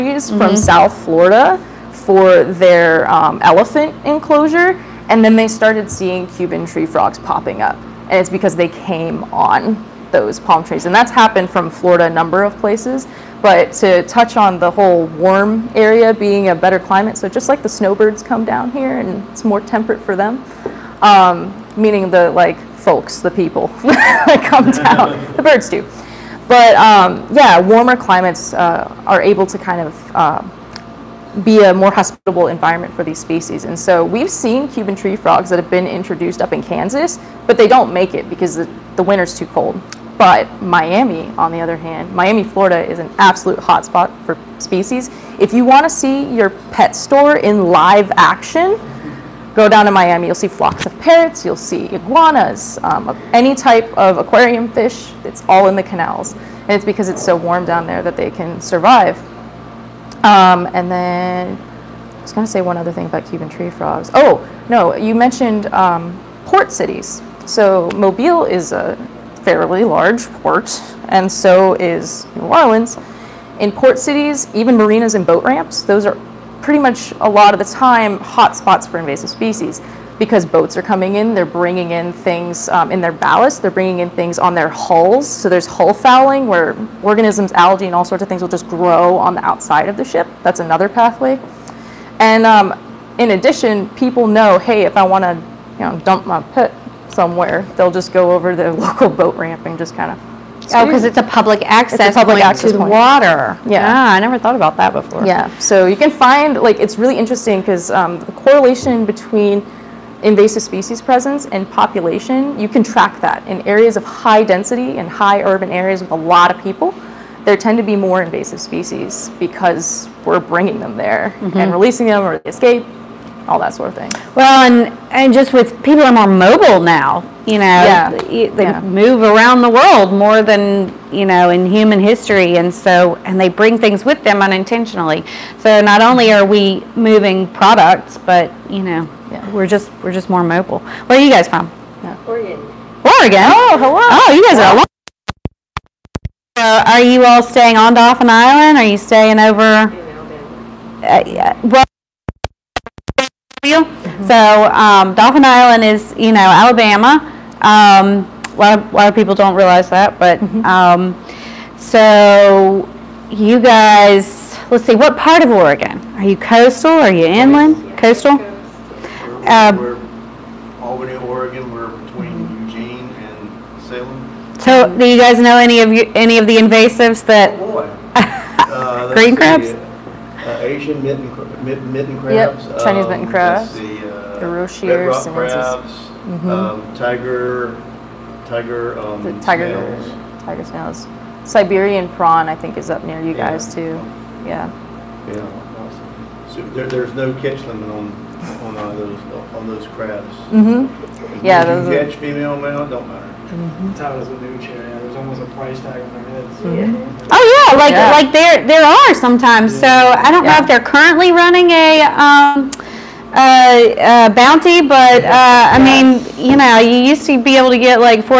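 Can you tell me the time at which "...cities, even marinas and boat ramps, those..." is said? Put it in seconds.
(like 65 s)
73 s.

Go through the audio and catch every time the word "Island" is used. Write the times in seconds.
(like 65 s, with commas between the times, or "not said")
148 s, 155 s.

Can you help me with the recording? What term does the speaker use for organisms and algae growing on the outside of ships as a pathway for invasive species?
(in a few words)
Hull fouling.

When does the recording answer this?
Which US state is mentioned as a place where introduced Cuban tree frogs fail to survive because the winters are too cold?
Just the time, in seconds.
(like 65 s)
36 s.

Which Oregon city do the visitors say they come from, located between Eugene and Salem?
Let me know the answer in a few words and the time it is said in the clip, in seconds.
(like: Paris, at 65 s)
Albany, at 170 s.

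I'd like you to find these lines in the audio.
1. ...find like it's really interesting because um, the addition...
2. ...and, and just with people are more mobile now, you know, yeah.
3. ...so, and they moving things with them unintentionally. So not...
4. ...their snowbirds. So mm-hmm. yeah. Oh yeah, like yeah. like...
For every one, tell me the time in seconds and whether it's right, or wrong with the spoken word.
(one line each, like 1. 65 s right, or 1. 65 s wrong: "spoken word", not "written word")
1. 106 s wrong: "correlation", not "addition"
2. 124 s right
3. 132 s wrong: "bring", not "moving"
4. 206 s wrong: "heads", not "snowbirds".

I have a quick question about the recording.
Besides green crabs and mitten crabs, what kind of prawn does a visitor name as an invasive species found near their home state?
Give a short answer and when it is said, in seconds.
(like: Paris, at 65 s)
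Siberian prawn, at 191 s.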